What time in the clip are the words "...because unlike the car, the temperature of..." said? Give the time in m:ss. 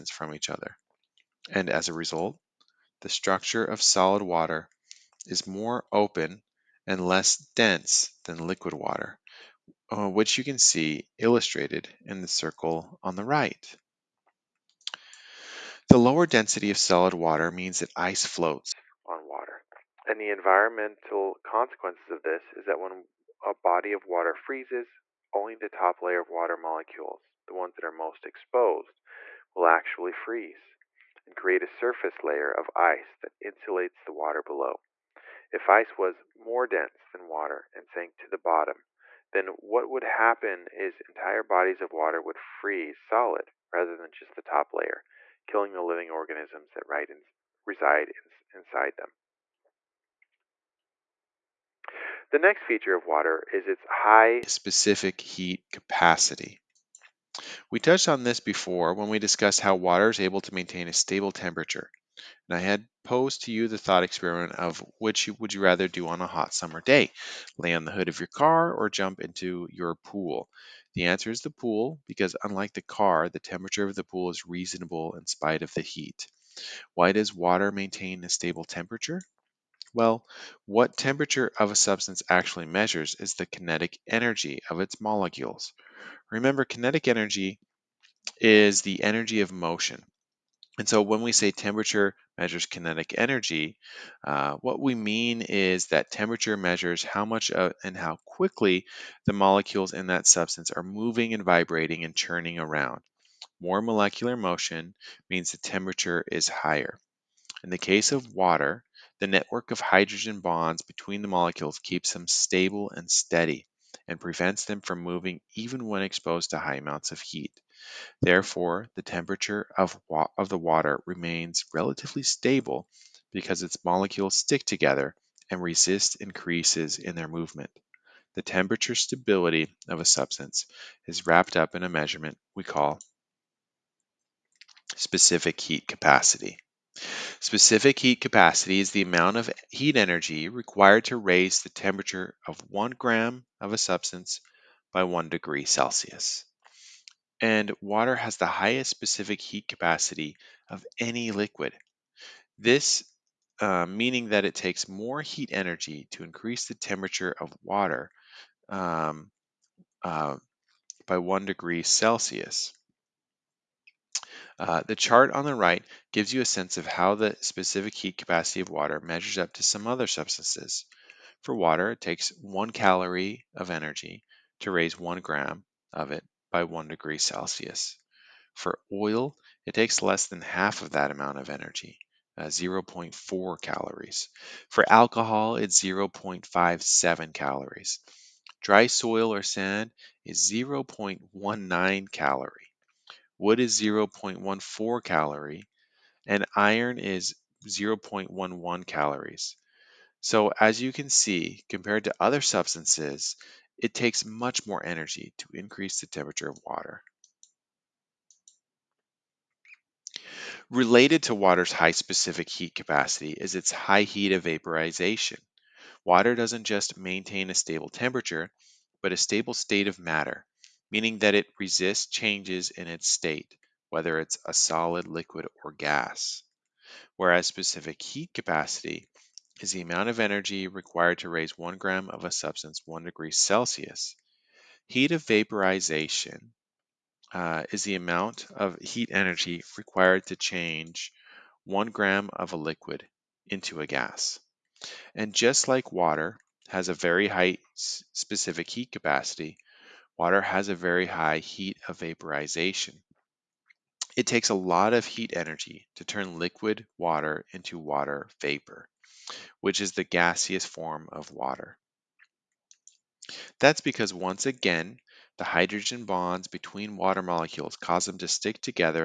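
1:12.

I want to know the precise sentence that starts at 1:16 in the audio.
Why does water maintain a stable temperature?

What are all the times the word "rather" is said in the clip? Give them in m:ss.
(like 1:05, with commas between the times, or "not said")
0:43, 1:05.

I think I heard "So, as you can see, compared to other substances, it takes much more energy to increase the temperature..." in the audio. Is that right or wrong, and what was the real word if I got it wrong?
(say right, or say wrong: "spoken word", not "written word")
right.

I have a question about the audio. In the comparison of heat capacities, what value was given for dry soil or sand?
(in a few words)
0.19 calorie.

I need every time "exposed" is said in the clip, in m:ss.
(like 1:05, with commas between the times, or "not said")
0:28, 1:56.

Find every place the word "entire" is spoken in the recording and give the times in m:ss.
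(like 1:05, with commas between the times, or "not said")
0:40.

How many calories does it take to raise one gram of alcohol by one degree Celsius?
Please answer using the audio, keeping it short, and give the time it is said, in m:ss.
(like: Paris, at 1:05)
0.57 calories, at 3:05.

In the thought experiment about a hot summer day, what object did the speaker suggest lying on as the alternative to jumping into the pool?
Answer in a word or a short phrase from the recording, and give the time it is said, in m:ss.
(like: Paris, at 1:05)
Hood of your car, at 1:07.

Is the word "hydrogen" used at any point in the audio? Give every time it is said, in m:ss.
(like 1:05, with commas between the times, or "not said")
1:49, 4:25.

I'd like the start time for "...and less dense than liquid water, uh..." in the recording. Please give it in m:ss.
0:06.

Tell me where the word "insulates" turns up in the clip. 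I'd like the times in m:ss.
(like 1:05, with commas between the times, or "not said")
0:33.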